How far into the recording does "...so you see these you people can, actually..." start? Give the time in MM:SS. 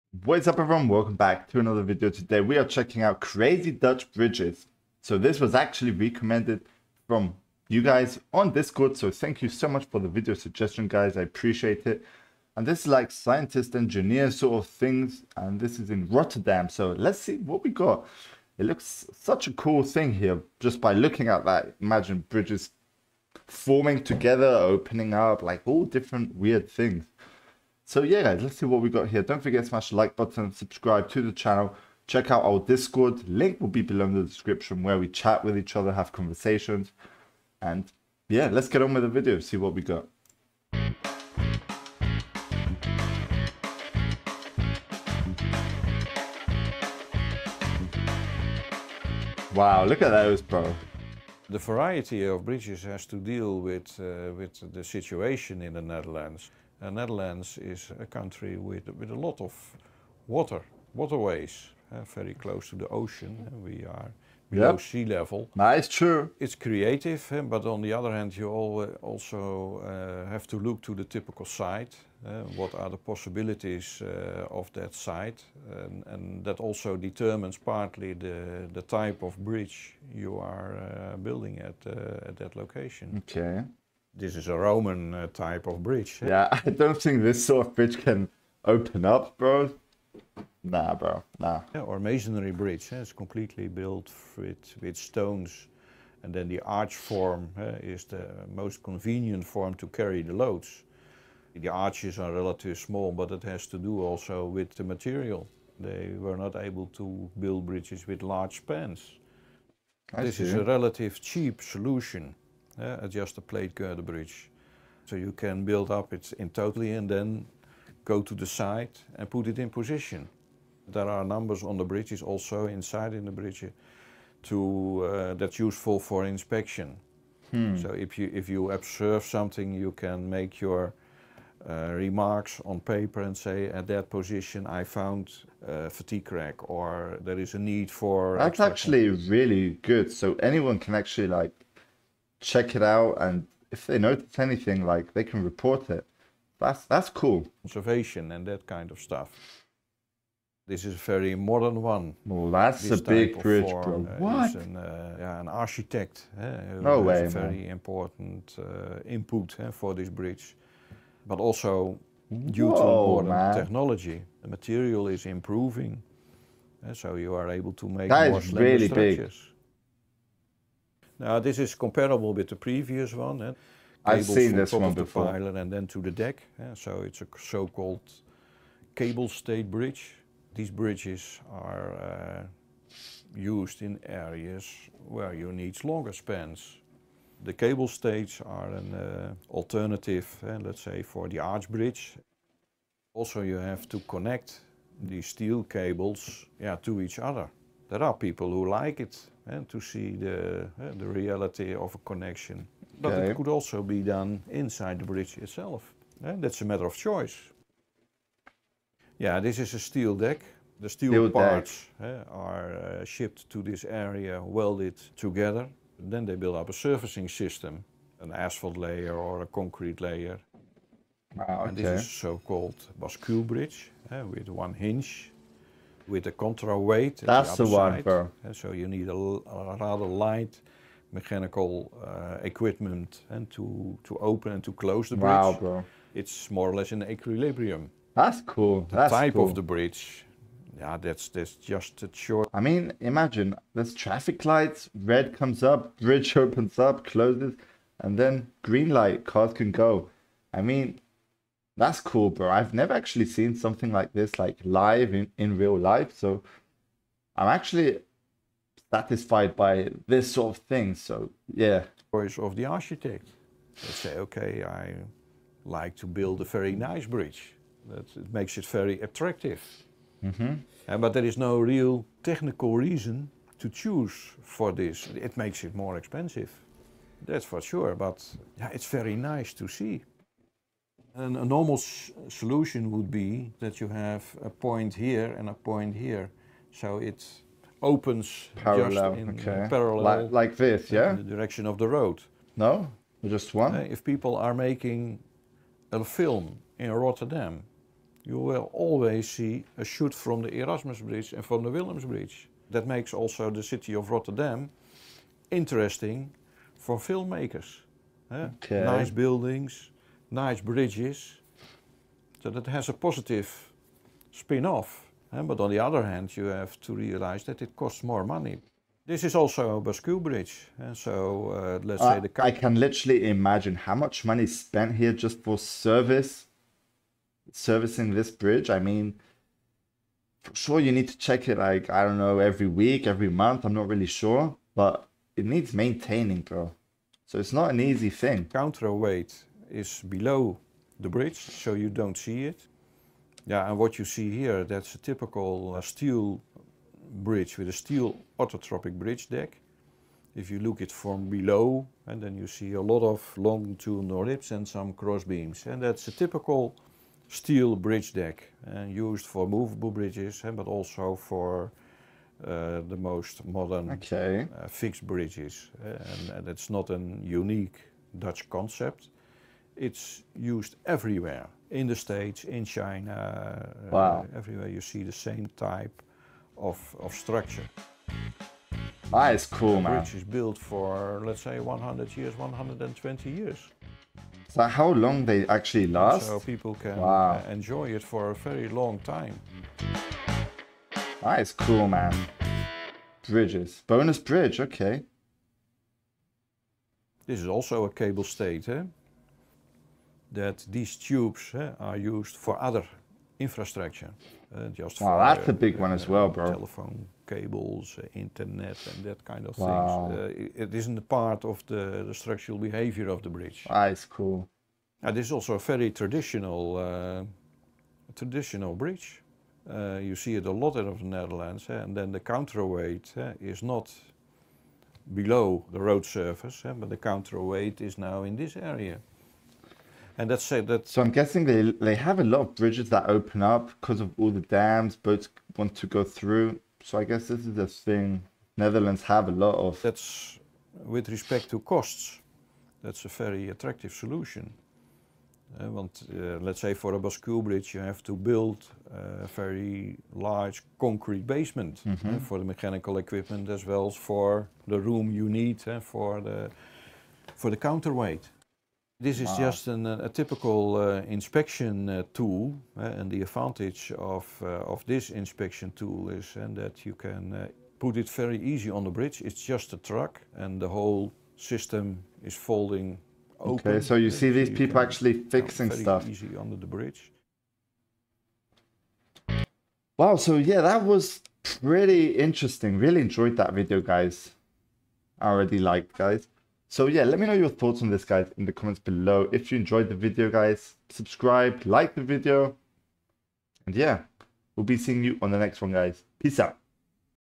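07:53.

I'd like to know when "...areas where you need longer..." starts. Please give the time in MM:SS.
03:04.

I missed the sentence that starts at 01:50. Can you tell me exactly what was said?
is a relative cheap solution yeah, adjust the plate girder bridge.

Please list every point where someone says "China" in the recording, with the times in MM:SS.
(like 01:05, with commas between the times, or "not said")
06:12.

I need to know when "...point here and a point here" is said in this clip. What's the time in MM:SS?
04:44.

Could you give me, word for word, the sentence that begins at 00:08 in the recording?
So thank you so much for the video suggestion guys, I appreciate it.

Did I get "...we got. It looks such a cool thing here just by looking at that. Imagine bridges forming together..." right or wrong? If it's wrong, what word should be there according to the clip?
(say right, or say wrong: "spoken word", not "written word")
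right.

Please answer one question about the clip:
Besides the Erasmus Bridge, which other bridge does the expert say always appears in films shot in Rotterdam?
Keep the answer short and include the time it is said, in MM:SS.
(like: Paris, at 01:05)
Willems Bridge, at 05:01.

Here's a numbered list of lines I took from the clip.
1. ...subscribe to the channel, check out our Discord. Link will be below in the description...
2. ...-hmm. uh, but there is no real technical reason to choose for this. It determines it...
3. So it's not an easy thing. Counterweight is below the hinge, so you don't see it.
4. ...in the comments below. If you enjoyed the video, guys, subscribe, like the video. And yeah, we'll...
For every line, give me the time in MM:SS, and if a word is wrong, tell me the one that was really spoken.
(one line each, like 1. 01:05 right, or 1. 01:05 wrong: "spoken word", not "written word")
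1. 00:30 right
2. 04:30 wrong: "makes", not "determines"
3. 05:37 wrong: "bridge", not "hinge"
4. 08:08 right.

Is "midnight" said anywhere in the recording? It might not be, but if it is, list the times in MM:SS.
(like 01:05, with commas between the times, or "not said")
not said.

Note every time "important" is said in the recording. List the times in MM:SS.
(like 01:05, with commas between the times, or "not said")
02:37.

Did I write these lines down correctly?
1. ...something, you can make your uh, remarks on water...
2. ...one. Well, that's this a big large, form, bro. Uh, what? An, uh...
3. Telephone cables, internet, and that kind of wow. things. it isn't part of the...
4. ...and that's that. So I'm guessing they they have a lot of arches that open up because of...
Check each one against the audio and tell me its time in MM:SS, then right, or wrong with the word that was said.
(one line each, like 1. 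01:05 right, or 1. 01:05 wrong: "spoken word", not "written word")
1. 02:09 wrong: "paper", not "water"
2. 02:31 wrong: "bridge", not "large"
3. 06:46 right
4. 07:10 wrong: "bridges", not "arches".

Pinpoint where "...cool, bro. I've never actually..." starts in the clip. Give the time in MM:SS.
04:12.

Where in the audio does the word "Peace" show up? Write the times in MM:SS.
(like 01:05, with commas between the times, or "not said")
08:16.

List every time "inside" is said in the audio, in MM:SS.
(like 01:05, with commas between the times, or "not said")
02:02, 03:24.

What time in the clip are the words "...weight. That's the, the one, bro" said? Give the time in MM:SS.
03:46.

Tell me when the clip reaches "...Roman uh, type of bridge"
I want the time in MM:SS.
01:24.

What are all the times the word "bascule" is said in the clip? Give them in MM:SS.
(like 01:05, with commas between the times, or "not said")
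03:42, 05:19, 07:26.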